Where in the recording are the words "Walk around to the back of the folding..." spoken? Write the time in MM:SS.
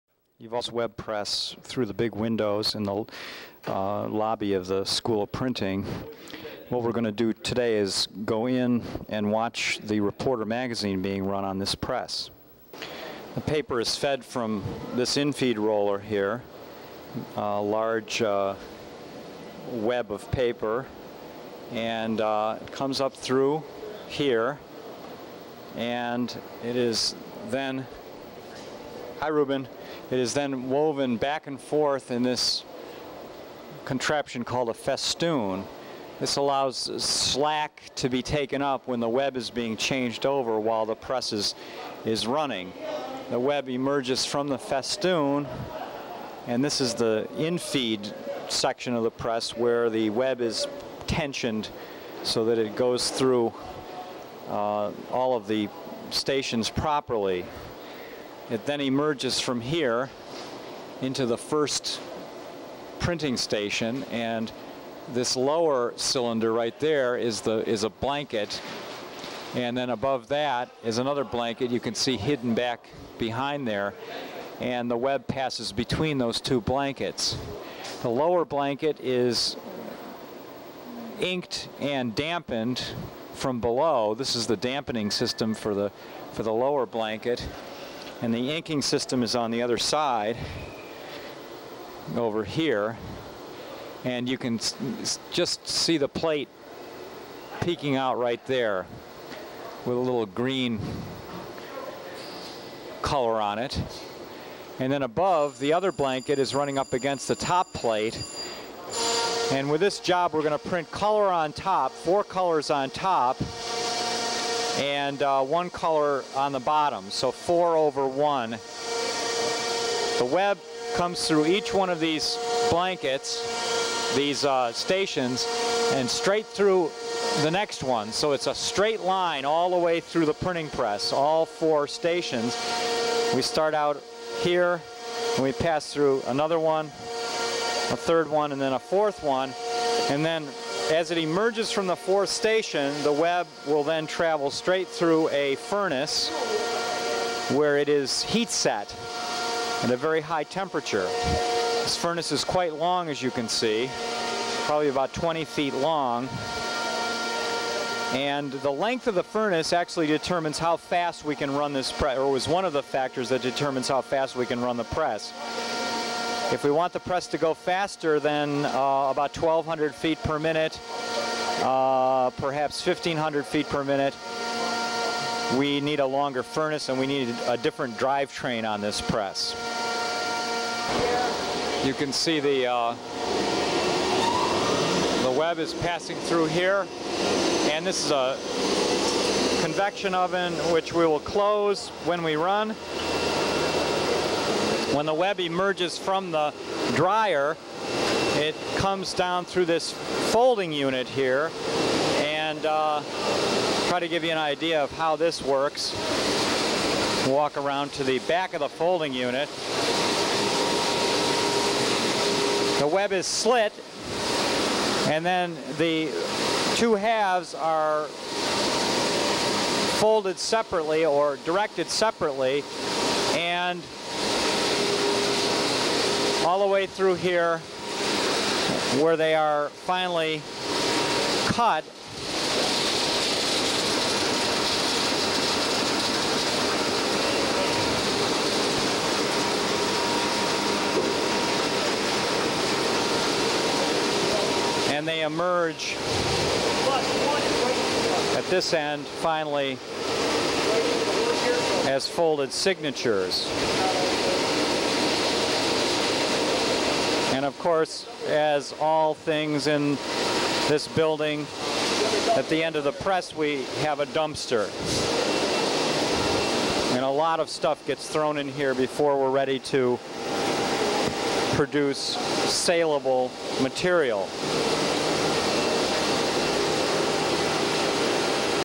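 03:27.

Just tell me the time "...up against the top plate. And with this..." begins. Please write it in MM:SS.
01:46.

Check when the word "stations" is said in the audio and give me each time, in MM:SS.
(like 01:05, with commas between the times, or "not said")
00:56, 01:03, 02:04, 02:11, 02:22.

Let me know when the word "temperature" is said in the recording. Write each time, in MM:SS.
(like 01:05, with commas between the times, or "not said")
02:30.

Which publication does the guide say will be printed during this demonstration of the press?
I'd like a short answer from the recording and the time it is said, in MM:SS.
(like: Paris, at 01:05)
the Reporter magazine, at 00:09.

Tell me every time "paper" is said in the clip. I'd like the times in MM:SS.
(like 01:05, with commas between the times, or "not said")
00:13, 00:20.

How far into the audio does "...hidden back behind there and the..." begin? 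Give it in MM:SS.
01:12.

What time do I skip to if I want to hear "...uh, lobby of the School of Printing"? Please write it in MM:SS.
00:03.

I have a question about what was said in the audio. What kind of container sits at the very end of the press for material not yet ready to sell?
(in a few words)
a dumpster.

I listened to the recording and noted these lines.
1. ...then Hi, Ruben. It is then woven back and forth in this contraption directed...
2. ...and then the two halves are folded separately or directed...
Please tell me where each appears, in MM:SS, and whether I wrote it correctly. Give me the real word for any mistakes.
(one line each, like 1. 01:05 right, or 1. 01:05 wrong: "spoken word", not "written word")
1. 00:27 wrong: "called", not "directed"
2. 03:35 right.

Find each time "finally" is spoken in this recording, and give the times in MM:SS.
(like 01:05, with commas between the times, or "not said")
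03:49, 04:09.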